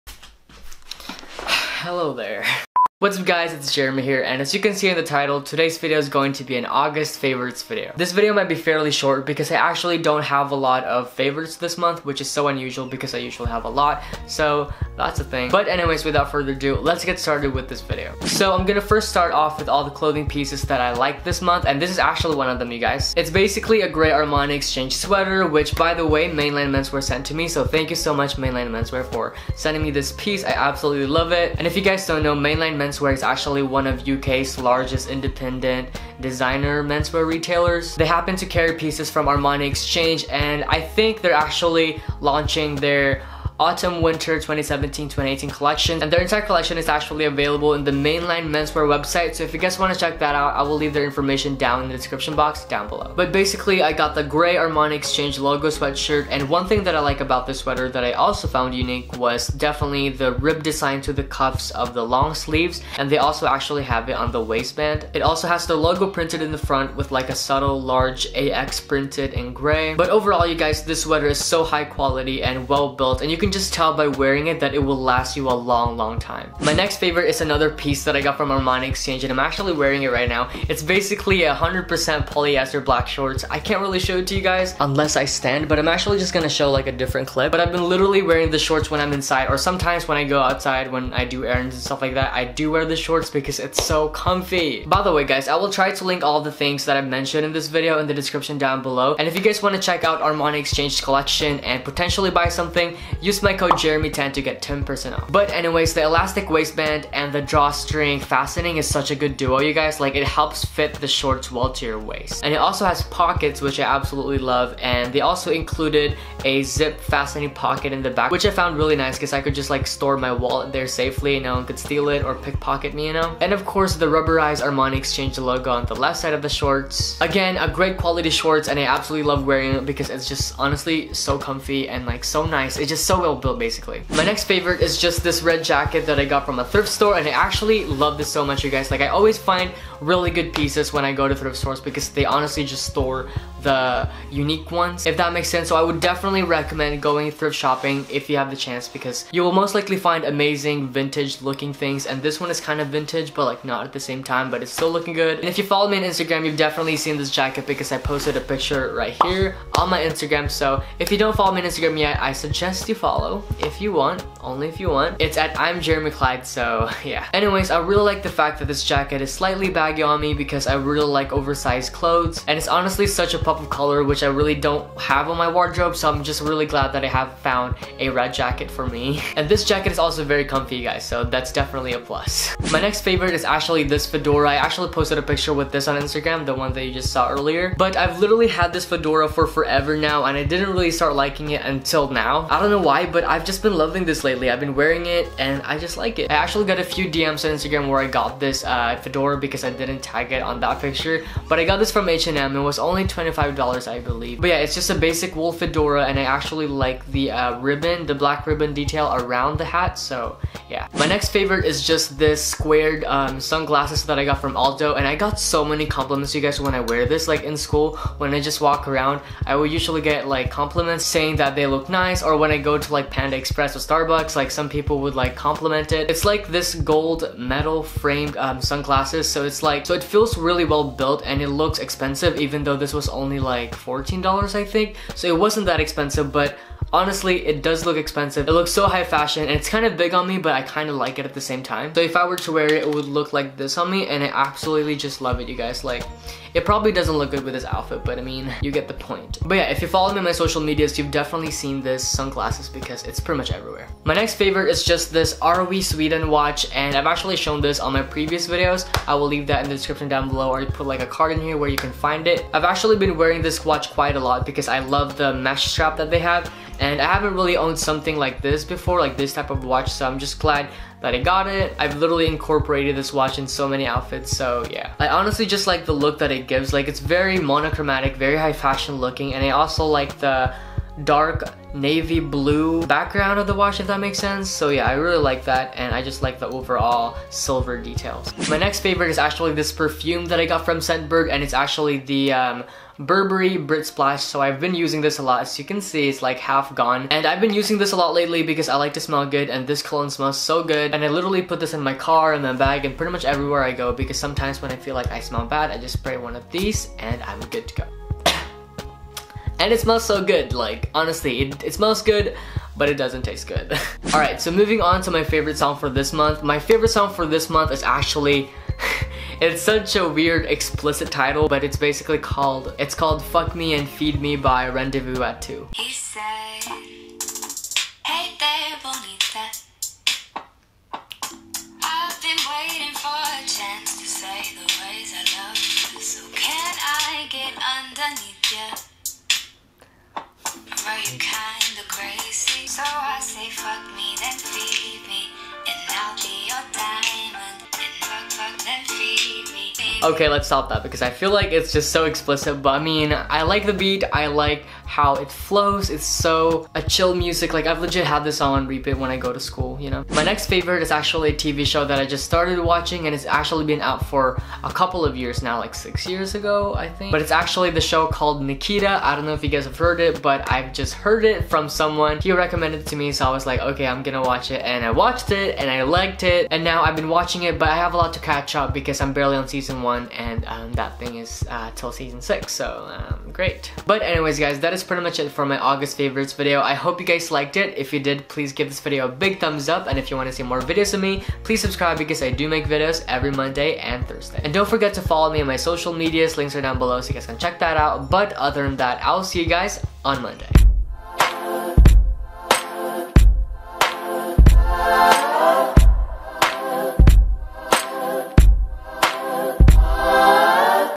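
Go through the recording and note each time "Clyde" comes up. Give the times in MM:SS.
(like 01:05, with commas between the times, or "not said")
02:46.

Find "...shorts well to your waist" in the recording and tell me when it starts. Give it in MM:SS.
01:51.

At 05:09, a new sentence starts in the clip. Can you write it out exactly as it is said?
and it smells so good, like honestly, it, it smells good but it doesn't taste good.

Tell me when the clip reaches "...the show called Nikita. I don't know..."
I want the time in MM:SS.
06:07.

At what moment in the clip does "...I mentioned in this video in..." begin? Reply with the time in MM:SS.
01:36.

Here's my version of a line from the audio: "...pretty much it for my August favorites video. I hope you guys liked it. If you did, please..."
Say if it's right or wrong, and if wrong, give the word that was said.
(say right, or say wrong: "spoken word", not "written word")
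right.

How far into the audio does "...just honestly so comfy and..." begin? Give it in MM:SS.
02:10.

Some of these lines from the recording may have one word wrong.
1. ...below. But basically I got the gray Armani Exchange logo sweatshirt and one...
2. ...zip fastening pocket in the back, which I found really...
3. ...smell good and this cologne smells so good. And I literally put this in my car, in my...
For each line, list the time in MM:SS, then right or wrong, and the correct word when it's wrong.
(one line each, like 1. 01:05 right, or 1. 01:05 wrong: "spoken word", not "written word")
1. 00:52 right
2. 01:56 right
3. 04:58 right.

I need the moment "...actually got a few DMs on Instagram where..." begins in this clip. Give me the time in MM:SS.
03:16.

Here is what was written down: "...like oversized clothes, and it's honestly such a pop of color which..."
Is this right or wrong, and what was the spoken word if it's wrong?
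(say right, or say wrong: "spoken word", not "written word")
right.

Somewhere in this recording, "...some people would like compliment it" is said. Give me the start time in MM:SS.
03:44.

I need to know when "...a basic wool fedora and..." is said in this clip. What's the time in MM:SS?
03:24.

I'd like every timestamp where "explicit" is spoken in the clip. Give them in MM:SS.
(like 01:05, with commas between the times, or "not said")
05:20, 05:52.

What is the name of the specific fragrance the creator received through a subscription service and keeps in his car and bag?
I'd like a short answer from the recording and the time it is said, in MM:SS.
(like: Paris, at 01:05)
Burberry Brit Splash, at 04:53.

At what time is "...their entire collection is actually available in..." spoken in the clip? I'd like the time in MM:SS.
00:46.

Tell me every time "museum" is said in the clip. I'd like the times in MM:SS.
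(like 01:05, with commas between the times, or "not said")
not said.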